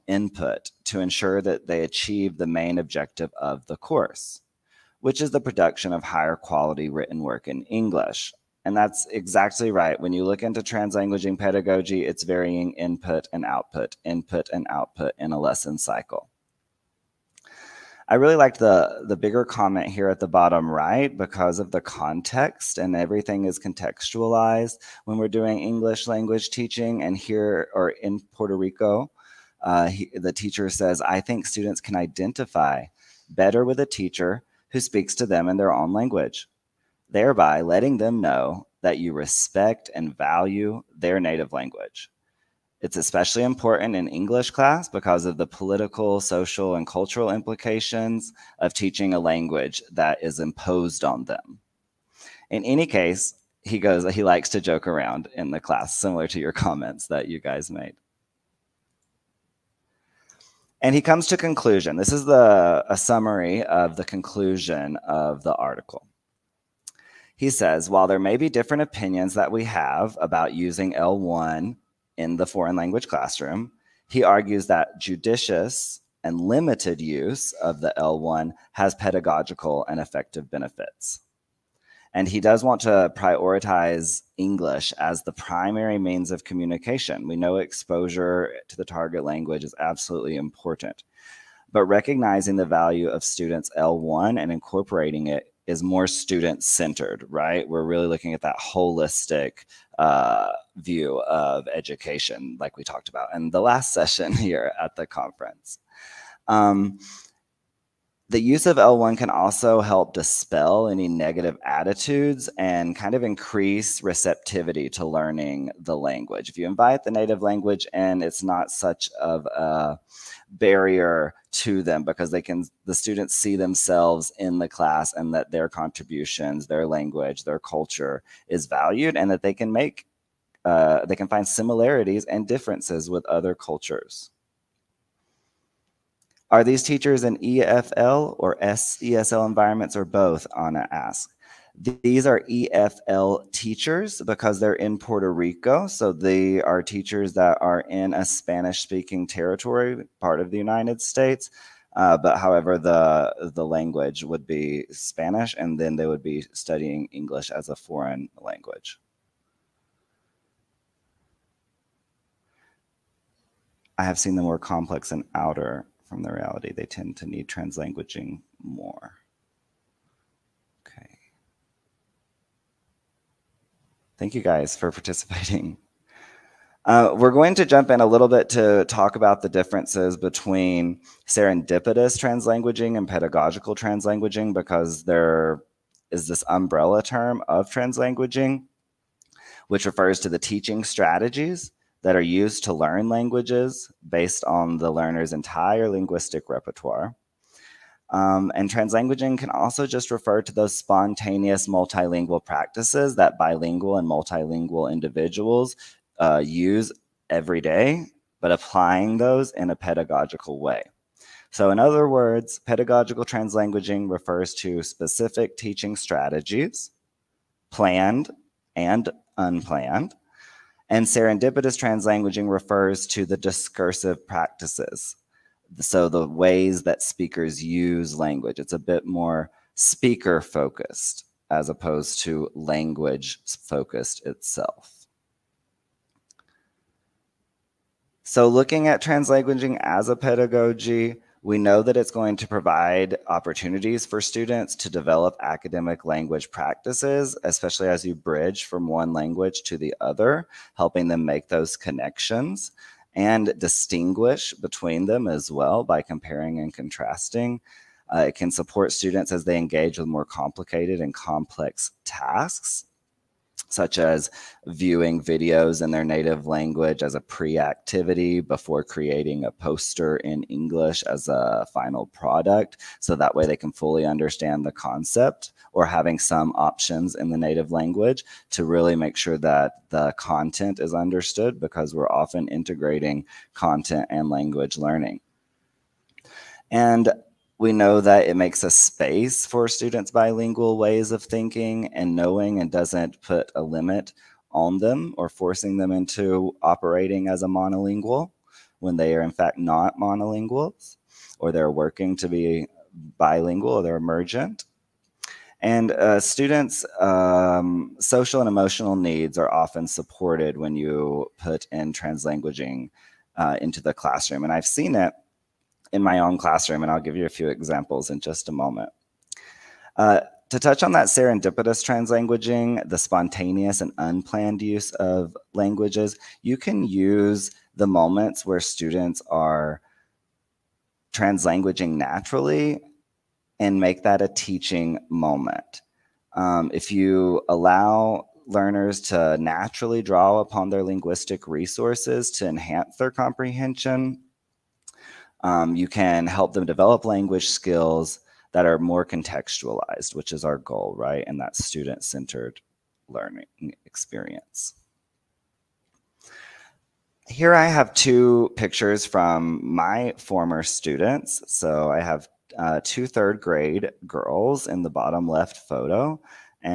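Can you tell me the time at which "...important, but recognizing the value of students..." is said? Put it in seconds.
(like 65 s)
90 s.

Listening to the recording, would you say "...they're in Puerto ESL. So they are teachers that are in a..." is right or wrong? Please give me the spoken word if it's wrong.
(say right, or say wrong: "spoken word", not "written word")
wrong: "Rico", not "ESL".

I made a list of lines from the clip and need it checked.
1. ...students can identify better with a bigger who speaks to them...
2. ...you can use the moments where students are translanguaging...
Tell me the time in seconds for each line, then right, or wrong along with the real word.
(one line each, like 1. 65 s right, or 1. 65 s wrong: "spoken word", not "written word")
1. 31 s wrong: "teacher", not "bigger"
2. 326 s right.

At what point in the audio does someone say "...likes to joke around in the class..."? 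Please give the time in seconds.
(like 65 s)
54 s.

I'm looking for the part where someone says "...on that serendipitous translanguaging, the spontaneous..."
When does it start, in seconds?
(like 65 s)
320 s.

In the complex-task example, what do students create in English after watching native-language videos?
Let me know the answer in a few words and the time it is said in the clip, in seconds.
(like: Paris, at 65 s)
A poster, at 269 s.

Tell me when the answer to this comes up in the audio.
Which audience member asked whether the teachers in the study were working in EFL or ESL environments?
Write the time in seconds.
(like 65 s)
140 s.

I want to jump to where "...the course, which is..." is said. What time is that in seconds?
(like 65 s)
3 s.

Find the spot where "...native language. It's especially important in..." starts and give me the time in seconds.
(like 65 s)
41 s.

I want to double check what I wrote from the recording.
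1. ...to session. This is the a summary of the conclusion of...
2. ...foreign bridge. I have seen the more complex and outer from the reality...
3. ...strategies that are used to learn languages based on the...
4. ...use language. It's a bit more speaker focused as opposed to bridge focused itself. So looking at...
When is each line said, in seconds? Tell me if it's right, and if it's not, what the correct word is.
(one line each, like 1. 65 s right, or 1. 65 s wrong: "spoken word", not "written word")
1. 61 s wrong: "conclusion", not "session"
2. 157 s wrong: "language", not "bridge"
3. 190 s right
4. 227 s wrong: "language", not "bridge".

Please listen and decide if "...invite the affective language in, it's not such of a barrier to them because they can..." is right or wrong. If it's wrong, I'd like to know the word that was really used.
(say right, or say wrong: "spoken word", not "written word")
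wrong: "native", not "affective".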